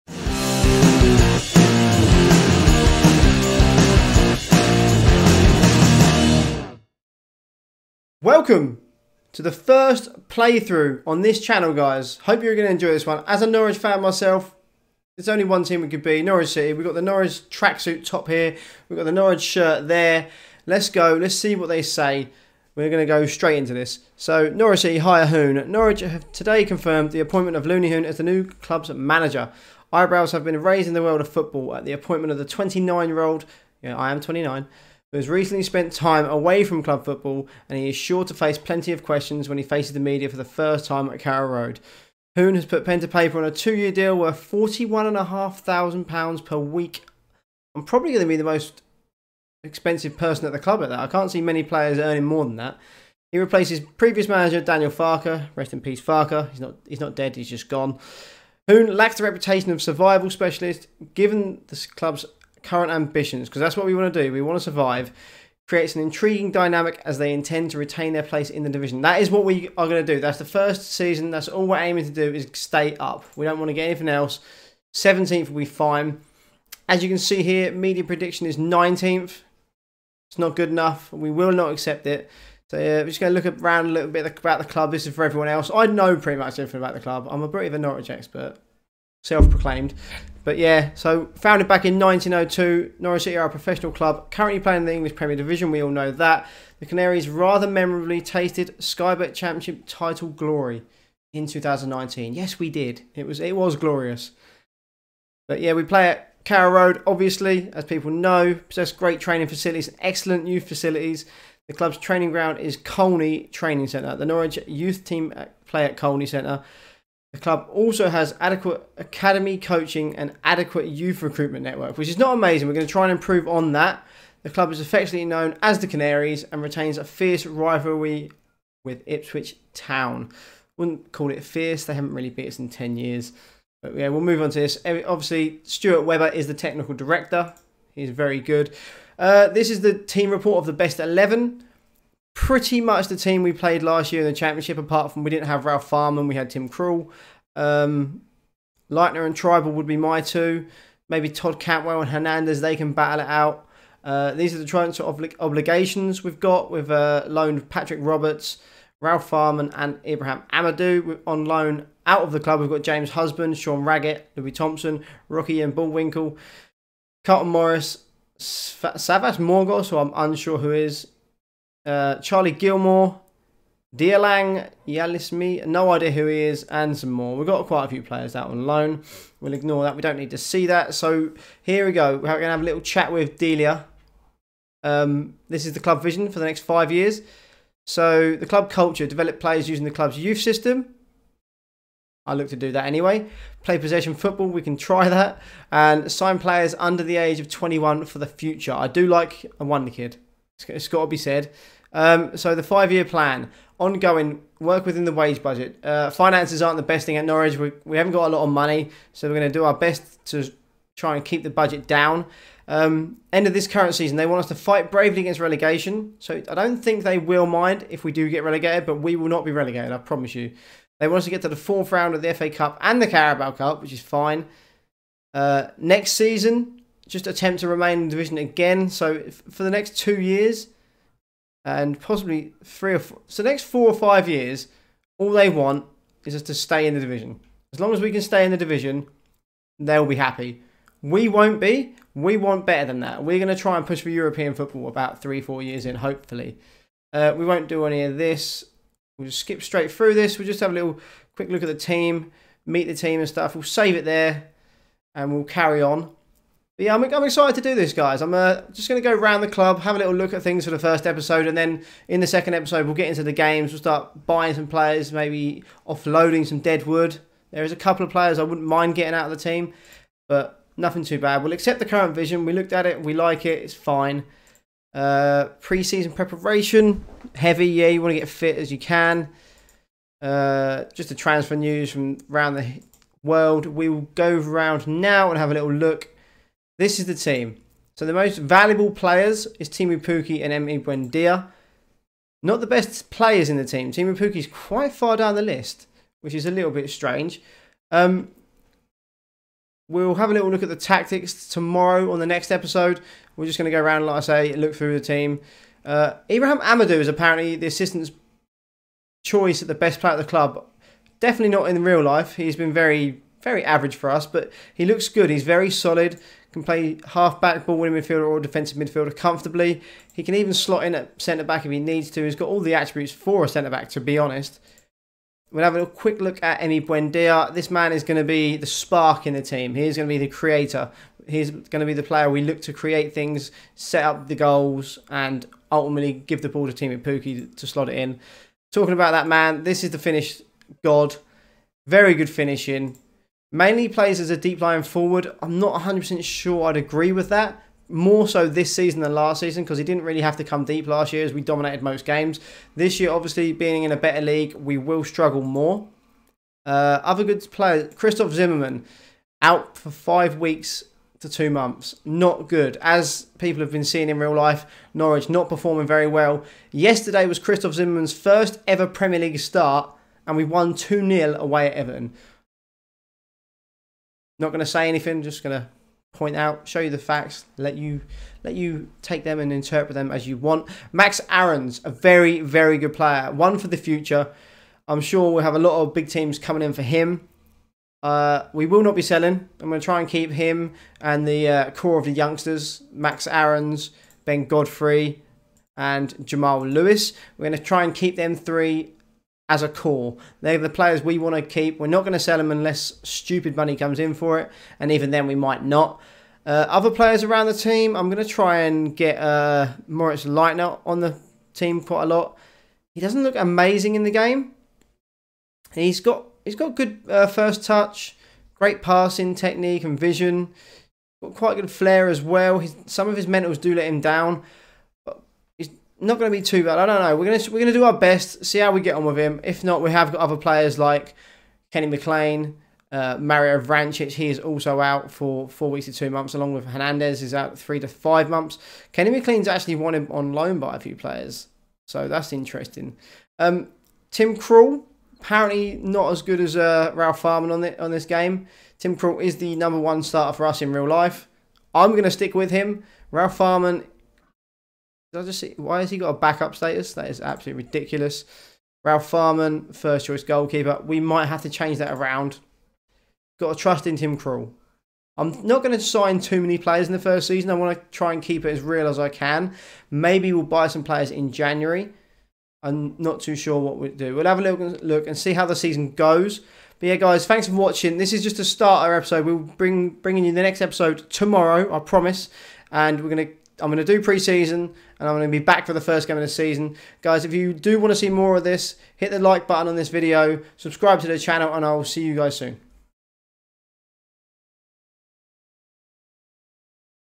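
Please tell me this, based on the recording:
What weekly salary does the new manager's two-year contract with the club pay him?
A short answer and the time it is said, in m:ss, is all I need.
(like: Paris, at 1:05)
£41,500, at 0:44.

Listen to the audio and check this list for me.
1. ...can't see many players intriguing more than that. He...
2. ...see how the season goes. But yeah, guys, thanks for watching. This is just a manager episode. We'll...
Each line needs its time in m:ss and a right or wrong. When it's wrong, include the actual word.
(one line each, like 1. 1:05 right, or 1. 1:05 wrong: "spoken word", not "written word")
1. 0:51 wrong: "earning", not "intriguing"
2. 7:55 wrong: "starter", not "manager".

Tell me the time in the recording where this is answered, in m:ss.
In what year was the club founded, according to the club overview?
1:31.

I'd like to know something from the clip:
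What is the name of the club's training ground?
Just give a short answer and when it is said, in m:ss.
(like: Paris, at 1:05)
Colney Training Centre, at 1:52.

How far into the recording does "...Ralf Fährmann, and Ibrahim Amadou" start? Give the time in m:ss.
2:38.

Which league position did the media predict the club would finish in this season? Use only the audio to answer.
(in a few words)
19th.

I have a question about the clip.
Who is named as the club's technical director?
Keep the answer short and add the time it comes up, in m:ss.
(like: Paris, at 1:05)
Stuart Webber, at 2:15.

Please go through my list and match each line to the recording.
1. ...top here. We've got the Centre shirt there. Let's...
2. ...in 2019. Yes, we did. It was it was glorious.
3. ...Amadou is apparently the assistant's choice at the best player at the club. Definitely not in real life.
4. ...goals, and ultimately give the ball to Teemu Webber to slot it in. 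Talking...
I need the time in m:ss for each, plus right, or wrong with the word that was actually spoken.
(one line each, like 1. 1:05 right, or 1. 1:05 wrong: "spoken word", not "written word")
1. 0:18 wrong: "Norwich", not "Centre"
2. 1:41 right
3. 5:06 right
4. 5:34 wrong: "Pukki", not "Webber".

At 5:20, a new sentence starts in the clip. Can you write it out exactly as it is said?
He can even slot in at centre-back if he needs to.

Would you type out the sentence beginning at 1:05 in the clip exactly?
Creates an intriguing dynamic as they intend to retain their place in the division.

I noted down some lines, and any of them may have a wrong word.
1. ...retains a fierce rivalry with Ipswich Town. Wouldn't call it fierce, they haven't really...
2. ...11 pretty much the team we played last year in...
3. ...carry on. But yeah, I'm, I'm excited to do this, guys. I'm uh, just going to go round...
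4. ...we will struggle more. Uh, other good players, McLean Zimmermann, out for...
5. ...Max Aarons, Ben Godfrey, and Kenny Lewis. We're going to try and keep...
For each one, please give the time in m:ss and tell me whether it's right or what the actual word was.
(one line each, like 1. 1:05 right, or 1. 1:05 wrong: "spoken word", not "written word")
1. 2:06 right
2. 2:20 right
3. 4:15 right
4. 5:54 wrong: "Christoph", not "McLean"
5. 6:32 wrong: "Jamal", not "Kenny".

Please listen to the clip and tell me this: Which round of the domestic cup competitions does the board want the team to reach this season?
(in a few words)
Fourth round.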